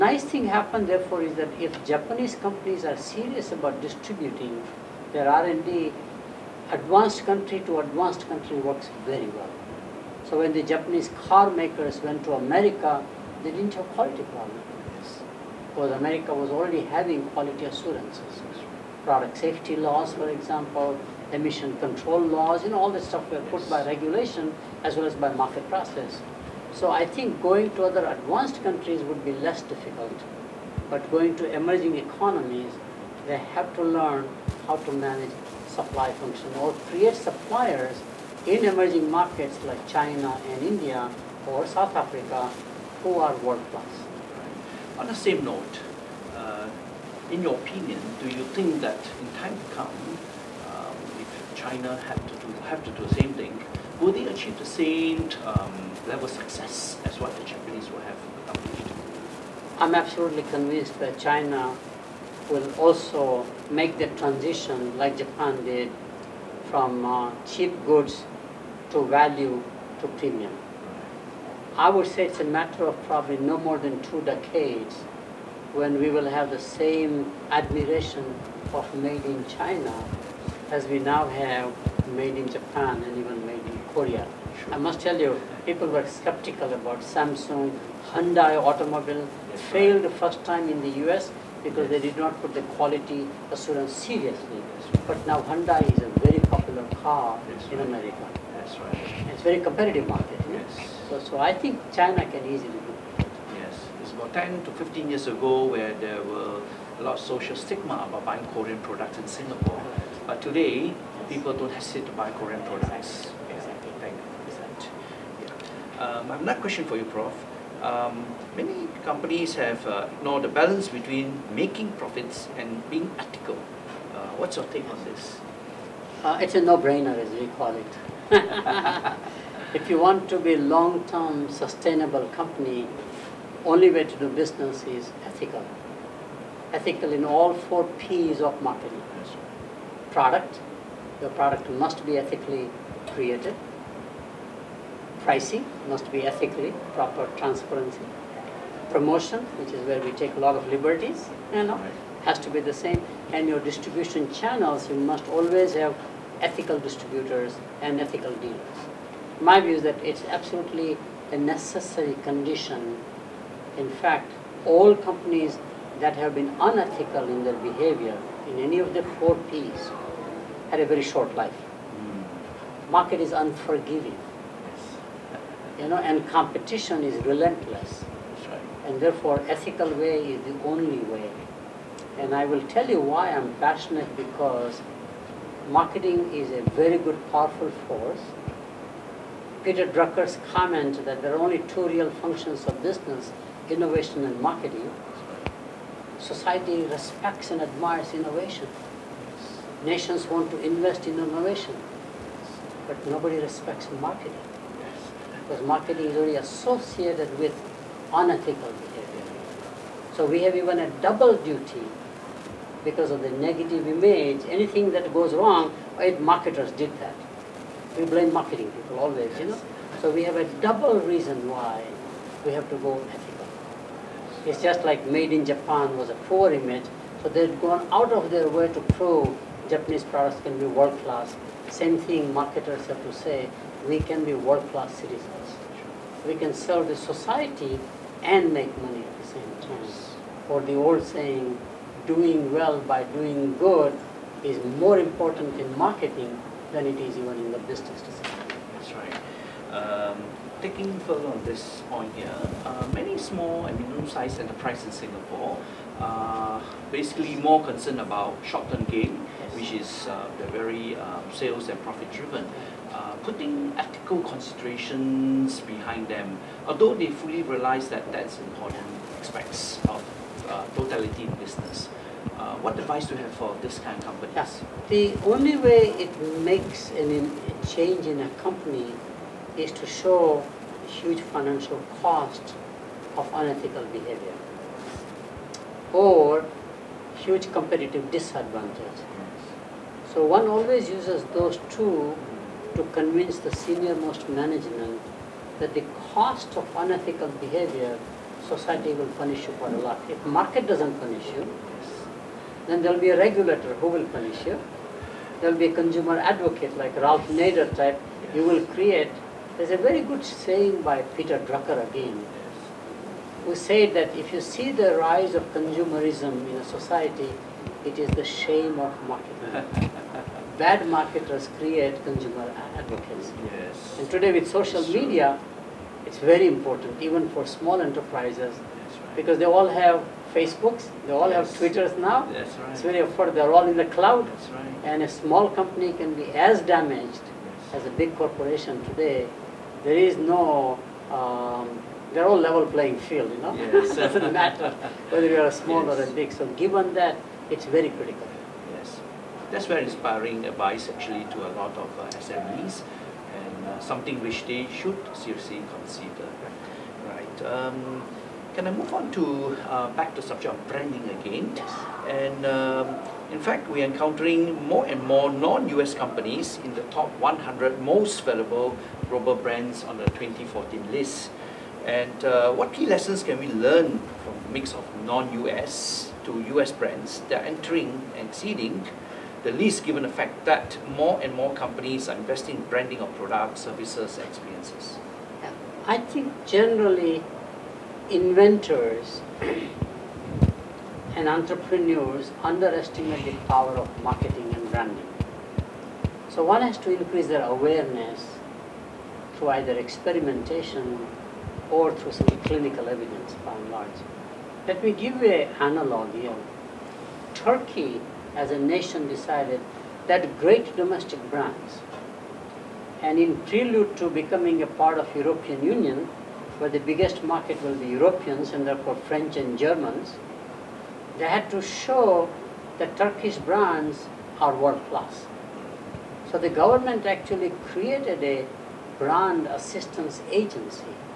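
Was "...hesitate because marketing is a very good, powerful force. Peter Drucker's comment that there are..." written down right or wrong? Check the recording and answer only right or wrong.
wrong.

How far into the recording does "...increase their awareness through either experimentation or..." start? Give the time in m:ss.
6:36.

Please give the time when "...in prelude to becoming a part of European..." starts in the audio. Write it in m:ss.
6:53.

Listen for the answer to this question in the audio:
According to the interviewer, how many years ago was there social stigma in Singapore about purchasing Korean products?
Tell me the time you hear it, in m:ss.
1:44.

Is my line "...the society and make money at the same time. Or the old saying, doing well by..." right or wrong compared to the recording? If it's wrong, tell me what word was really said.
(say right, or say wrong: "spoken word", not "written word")
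right.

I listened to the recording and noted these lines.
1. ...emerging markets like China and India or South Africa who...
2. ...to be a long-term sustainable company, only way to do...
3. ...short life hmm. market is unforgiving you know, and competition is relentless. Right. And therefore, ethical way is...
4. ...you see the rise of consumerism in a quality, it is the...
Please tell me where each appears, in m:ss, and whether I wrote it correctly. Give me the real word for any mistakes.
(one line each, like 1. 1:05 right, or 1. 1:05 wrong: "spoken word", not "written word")
1. 0:38 right
2. 2:10 right
3. 2:51 right
4. 5:14 wrong: "society", not "quality".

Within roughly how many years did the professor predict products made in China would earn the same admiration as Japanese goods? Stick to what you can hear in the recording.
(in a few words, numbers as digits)
2 decades.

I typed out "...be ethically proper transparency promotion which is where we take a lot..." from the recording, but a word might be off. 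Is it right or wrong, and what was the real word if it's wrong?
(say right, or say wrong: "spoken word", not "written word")
right.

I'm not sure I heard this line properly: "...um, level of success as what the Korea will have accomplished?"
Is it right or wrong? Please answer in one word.
wrong.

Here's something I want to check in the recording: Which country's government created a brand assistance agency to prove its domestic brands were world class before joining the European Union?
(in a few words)
Turkey.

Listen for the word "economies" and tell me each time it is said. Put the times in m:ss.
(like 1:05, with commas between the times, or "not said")
0:31.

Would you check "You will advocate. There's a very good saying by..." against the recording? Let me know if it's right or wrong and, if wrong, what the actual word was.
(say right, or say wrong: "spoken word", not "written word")
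wrong: "create", not "advocate".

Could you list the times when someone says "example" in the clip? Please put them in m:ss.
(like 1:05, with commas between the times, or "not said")
0:20.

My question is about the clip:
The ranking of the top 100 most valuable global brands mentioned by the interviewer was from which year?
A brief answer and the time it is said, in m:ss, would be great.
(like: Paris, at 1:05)
2014, at 6:10.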